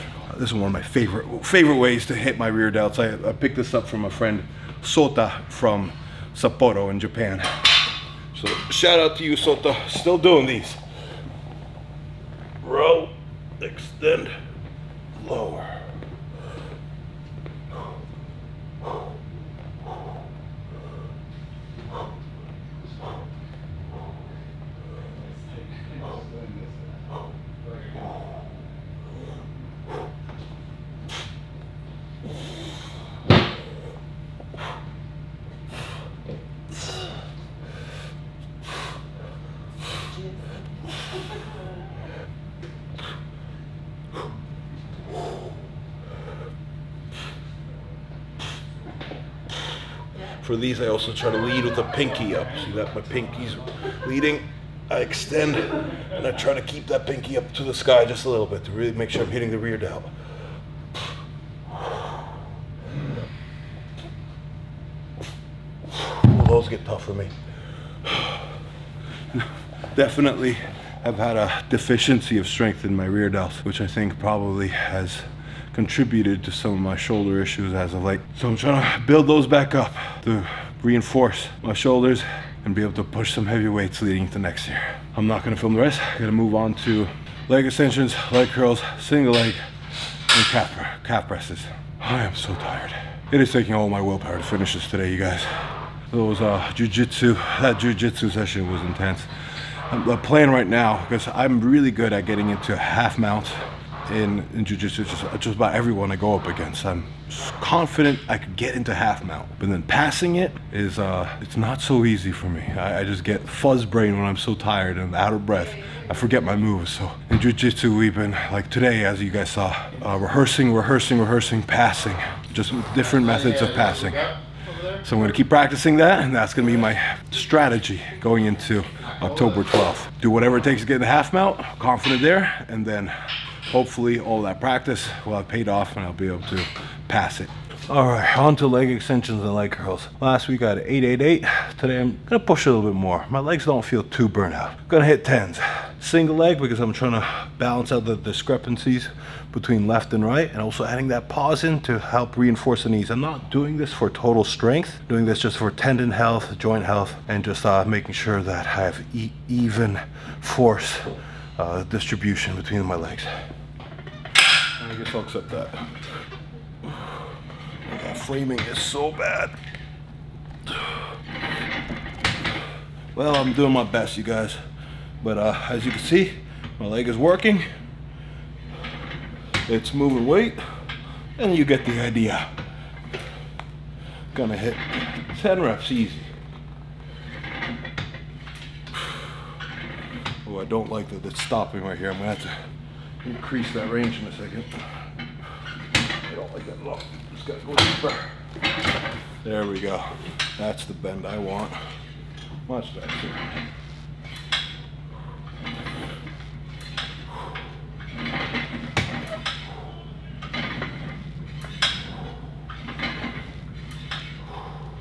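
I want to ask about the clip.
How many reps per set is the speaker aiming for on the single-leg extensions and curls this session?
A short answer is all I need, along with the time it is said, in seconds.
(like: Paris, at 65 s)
10, at 145 s.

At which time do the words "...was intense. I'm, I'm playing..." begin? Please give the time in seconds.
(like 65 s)
98 s.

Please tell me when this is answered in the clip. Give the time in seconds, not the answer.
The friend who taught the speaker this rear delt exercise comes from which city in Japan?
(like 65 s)
6 s.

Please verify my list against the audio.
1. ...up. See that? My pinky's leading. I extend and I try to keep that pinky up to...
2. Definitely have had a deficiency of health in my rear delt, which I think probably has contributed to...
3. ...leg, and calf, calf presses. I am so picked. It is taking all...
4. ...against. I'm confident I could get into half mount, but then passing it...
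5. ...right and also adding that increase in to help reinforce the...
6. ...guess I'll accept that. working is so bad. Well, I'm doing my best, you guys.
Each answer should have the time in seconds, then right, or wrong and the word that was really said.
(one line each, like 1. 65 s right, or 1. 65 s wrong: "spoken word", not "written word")
1. 52 s right
2. 69 s wrong: "strength", not "health"
3. 89 s wrong: "tired", not "picked"
4. 106 s right
5. 150 s wrong: "pause", not "increase"
6. 164 s wrong: "framing", not "working".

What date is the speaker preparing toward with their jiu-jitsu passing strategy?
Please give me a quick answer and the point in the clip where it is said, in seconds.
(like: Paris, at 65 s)
October 12th, at 129 s.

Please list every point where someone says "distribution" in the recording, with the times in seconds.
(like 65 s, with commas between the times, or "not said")
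161 s.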